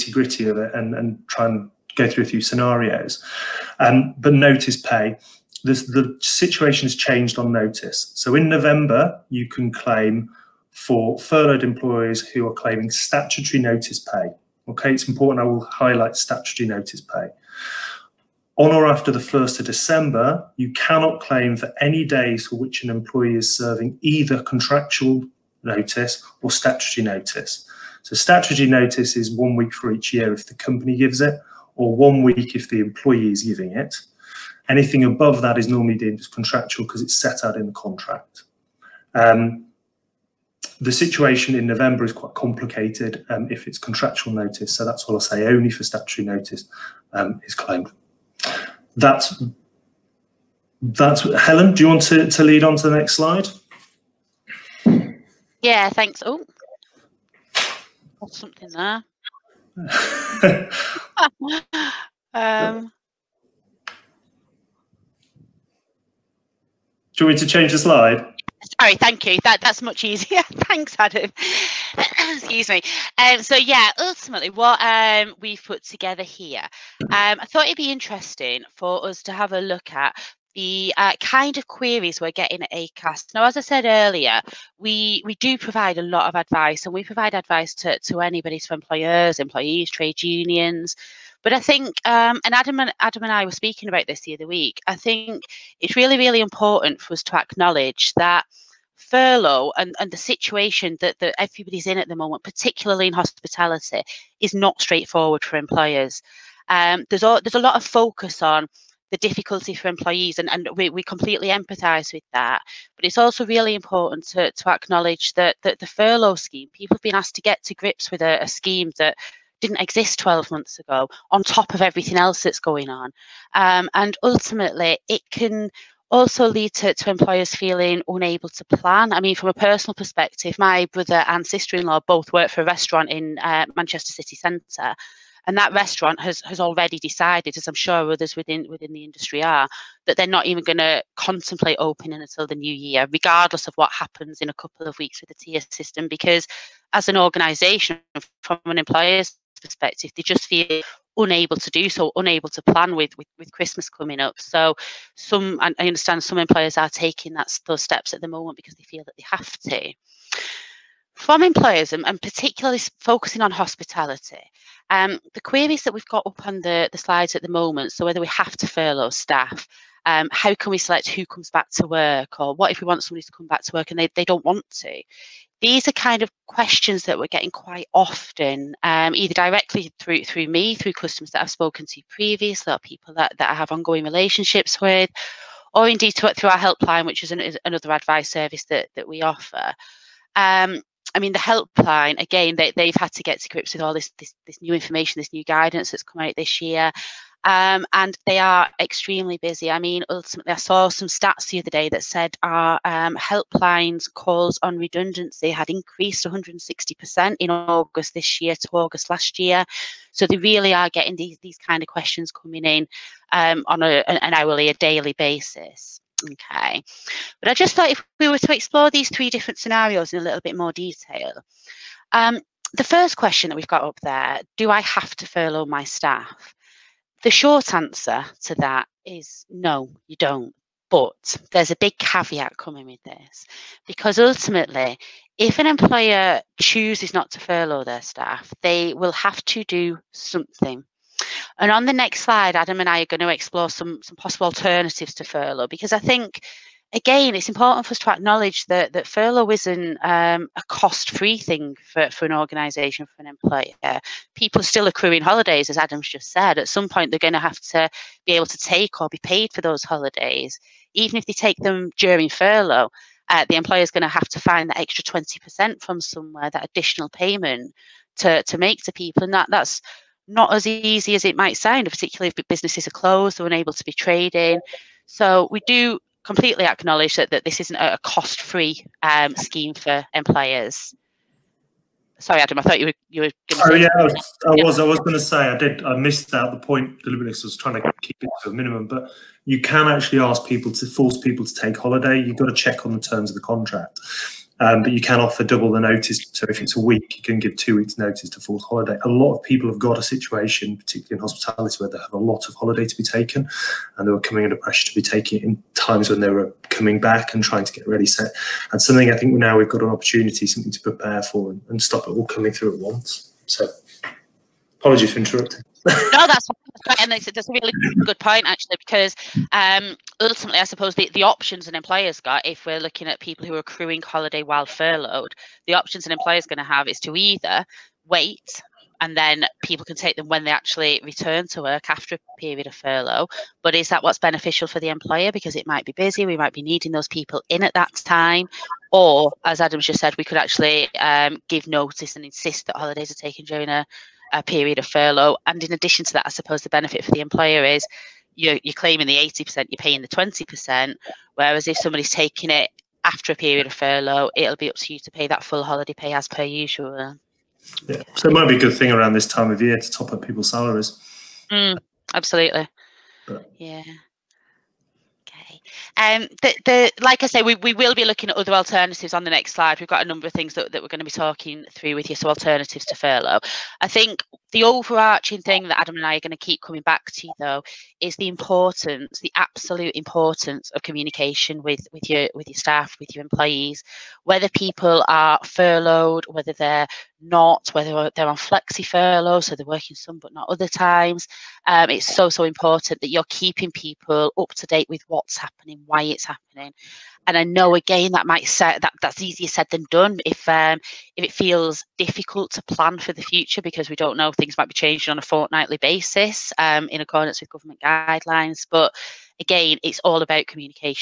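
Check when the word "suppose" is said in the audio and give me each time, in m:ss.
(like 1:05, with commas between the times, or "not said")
5:20, 5:46.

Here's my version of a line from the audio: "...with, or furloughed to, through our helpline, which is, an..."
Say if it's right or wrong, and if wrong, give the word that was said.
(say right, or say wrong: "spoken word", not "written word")
wrong: "indeed", not "furloughed".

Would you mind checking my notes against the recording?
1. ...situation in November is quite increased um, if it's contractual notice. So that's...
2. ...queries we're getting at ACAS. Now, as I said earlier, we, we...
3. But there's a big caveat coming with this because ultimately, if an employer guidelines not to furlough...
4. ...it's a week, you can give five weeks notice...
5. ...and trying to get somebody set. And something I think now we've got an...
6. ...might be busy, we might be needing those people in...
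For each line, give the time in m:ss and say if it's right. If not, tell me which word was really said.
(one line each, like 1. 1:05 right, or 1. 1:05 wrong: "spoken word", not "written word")
1. 0:40 wrong: "complicated", not "increased"
2. 1:21 right
3. 3:50 wrong: "chooses", not "guidelines"
4. 4:56 wrong: "two", not "five"
5. 5:07 wrong: "ready", not "somebody"
6. 5:35 right.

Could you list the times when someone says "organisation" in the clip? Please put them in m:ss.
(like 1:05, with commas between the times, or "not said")
2:27, 4:12.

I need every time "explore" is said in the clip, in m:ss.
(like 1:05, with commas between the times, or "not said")
3:38, 4:03.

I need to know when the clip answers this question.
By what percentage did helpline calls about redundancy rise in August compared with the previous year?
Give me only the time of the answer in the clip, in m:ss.
3:26.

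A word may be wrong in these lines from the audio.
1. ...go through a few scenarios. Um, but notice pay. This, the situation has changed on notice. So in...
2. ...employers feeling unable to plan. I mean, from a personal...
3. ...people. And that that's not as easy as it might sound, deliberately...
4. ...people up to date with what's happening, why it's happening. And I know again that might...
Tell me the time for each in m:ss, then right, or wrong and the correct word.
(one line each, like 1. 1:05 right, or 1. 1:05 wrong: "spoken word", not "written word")
1. 0:01 right
2. 2:07 right
3. 4:28 wrong: "particularly", not "deliberately"
4. 6:33 right.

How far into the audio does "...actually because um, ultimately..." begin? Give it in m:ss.
5:18.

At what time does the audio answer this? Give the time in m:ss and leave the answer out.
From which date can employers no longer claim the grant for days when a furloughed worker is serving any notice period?
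0:19.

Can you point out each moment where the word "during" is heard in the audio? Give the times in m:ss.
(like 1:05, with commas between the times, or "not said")
4:21, 5:43.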